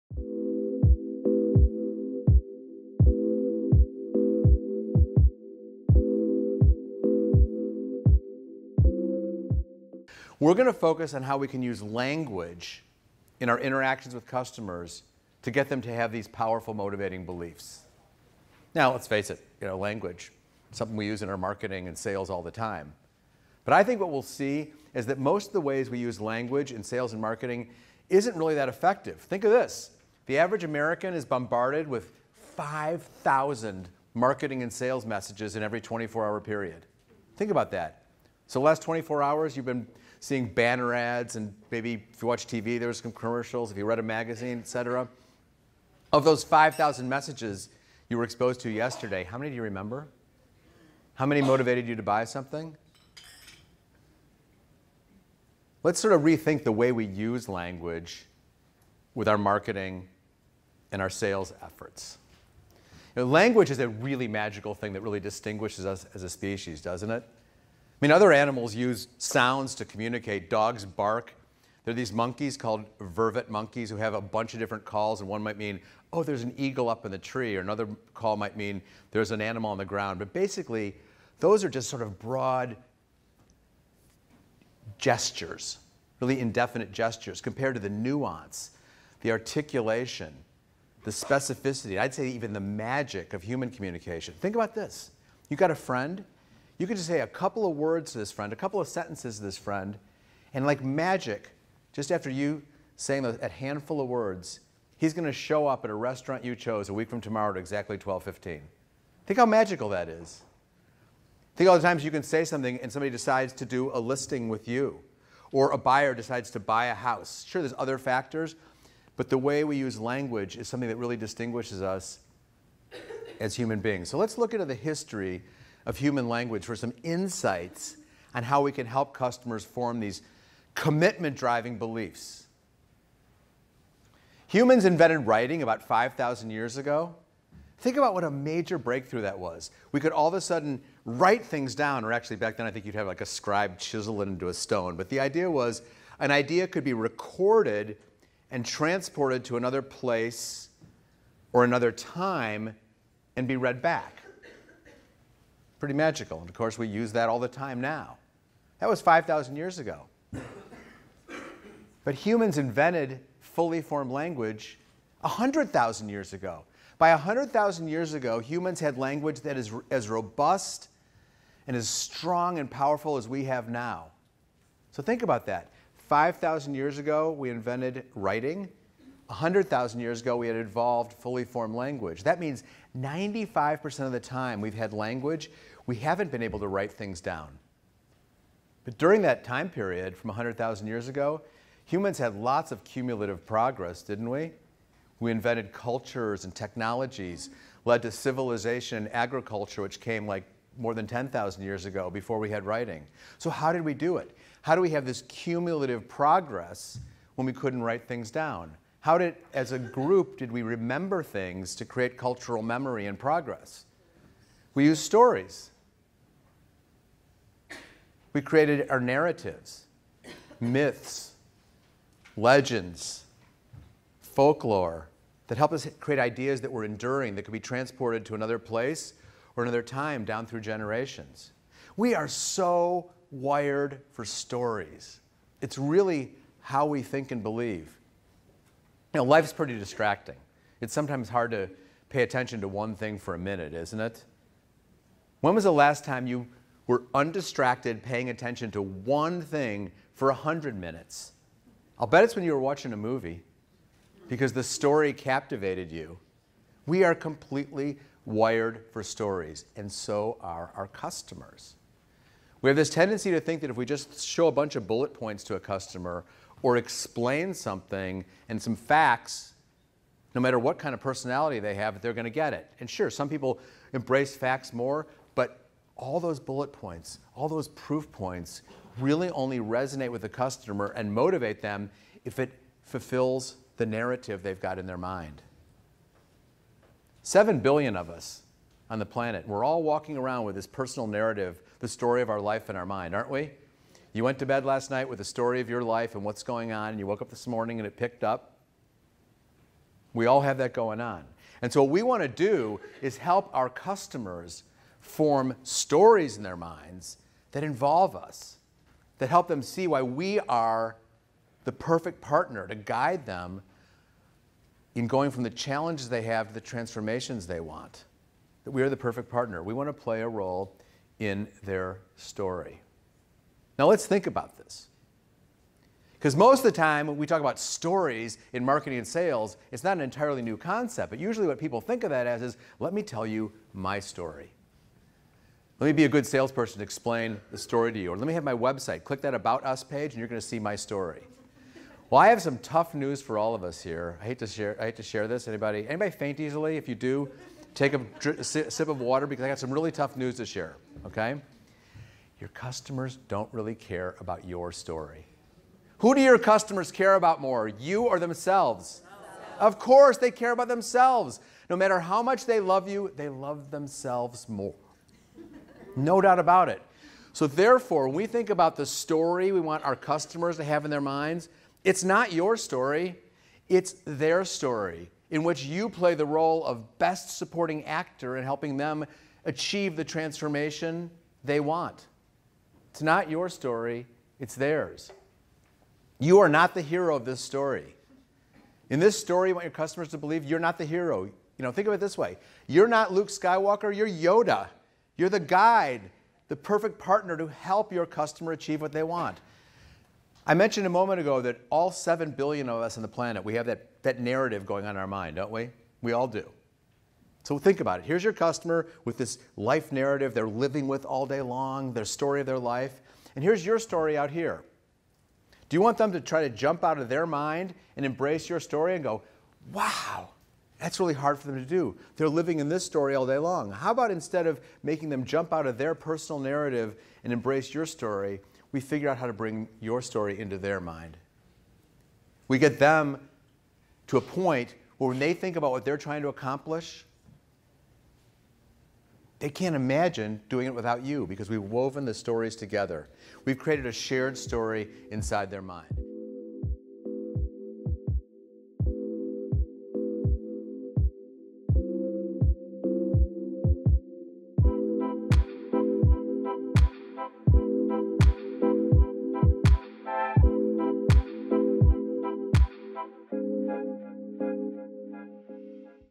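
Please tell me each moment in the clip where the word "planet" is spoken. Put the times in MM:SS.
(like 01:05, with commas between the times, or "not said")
04:49, 06:43.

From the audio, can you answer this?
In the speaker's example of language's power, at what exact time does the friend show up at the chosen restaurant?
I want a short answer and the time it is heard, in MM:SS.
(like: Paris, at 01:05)
12:15, at 01:47.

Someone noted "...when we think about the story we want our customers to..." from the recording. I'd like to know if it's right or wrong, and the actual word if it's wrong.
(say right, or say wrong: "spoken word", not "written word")
right.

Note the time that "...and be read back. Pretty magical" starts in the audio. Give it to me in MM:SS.
02:33.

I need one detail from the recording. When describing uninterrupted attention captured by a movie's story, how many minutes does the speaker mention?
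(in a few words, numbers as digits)
100 minutes.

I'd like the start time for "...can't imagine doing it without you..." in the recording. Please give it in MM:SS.
07:19.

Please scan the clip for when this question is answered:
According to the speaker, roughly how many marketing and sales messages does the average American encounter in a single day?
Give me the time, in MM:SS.
00:32.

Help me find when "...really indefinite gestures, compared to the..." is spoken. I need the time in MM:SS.
01:26.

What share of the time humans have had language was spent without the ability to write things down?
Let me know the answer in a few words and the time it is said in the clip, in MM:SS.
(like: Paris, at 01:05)
95%, at 03:02.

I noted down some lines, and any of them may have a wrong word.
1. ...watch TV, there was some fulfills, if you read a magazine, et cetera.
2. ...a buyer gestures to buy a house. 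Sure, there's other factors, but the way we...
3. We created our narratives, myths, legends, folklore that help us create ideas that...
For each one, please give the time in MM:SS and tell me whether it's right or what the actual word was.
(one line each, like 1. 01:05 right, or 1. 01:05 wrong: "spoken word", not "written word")
1. 00:42 wrong: "commercials", not "fulfills"
2. 01:55 wrong: "decides", not "gestures"
3. 03:38 right.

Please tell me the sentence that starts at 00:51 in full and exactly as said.
How many motivated you to buy something?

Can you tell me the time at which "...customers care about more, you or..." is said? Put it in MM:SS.
05:56.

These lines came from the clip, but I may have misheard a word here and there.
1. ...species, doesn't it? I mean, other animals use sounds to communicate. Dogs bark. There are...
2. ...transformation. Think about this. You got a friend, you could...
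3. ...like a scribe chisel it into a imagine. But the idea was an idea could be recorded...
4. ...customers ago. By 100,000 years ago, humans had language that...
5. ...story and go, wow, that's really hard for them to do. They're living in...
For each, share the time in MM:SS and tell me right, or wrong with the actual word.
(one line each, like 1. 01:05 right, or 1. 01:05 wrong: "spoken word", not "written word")
1. 01:06 right
2. 01:33 wrong: "communication", not "transformation"
3. 02:23 wrong: "stone", not "imagine"
4. 02:46 wrong: "years", not "customers"
5. 06:58 right.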